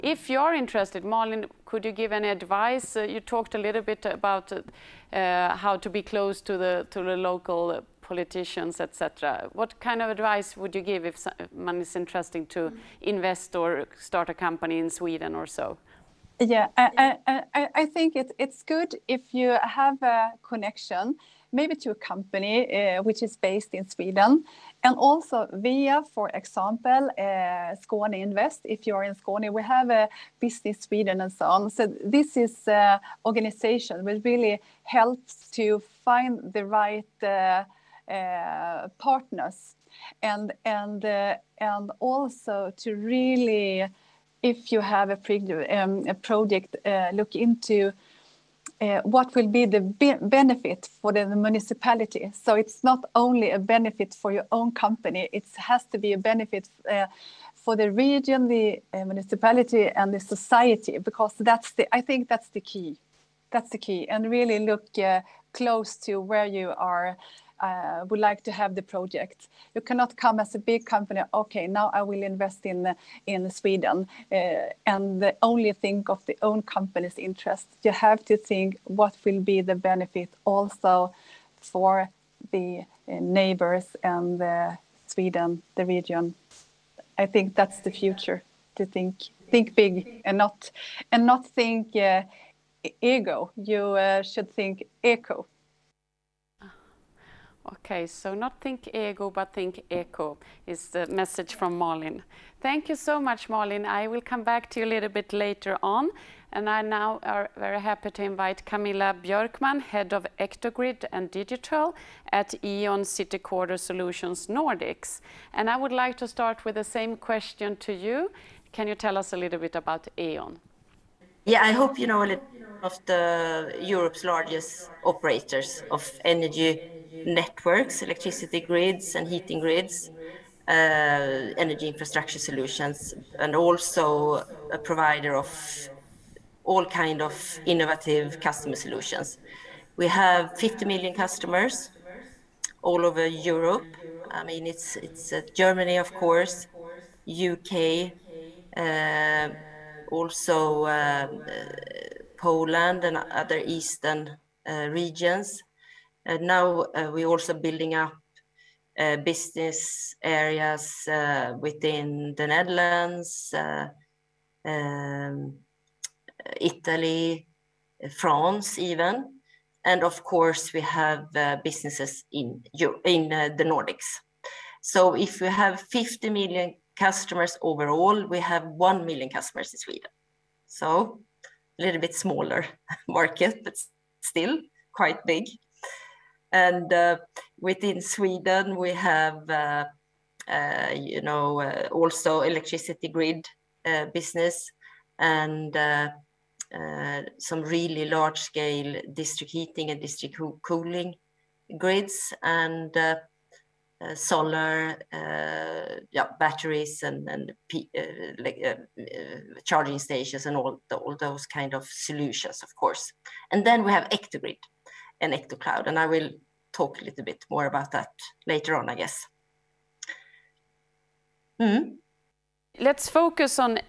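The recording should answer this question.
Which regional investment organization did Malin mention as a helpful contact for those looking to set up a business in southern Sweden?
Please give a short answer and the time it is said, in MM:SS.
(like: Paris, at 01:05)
Skåne Invest, at 00:27.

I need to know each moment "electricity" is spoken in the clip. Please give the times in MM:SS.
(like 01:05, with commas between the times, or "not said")
02:08, 03:12.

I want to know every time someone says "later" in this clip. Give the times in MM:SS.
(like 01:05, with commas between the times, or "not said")
01:45, 03:38.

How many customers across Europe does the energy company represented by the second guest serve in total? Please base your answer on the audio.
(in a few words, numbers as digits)
50 million.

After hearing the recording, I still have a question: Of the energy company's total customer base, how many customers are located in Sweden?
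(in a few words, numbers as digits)
1 million.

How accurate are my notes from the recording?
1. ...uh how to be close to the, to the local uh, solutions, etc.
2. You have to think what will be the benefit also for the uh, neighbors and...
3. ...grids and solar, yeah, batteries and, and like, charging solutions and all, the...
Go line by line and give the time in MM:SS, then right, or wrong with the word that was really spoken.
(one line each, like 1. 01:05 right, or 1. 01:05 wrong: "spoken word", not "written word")
1. 00:05 wrong: "politicians", not "solutions"
2. 01:17 right
3. 03:21 wrong: "stations", not "solutions".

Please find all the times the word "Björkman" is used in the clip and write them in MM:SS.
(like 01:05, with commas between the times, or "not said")
01:49.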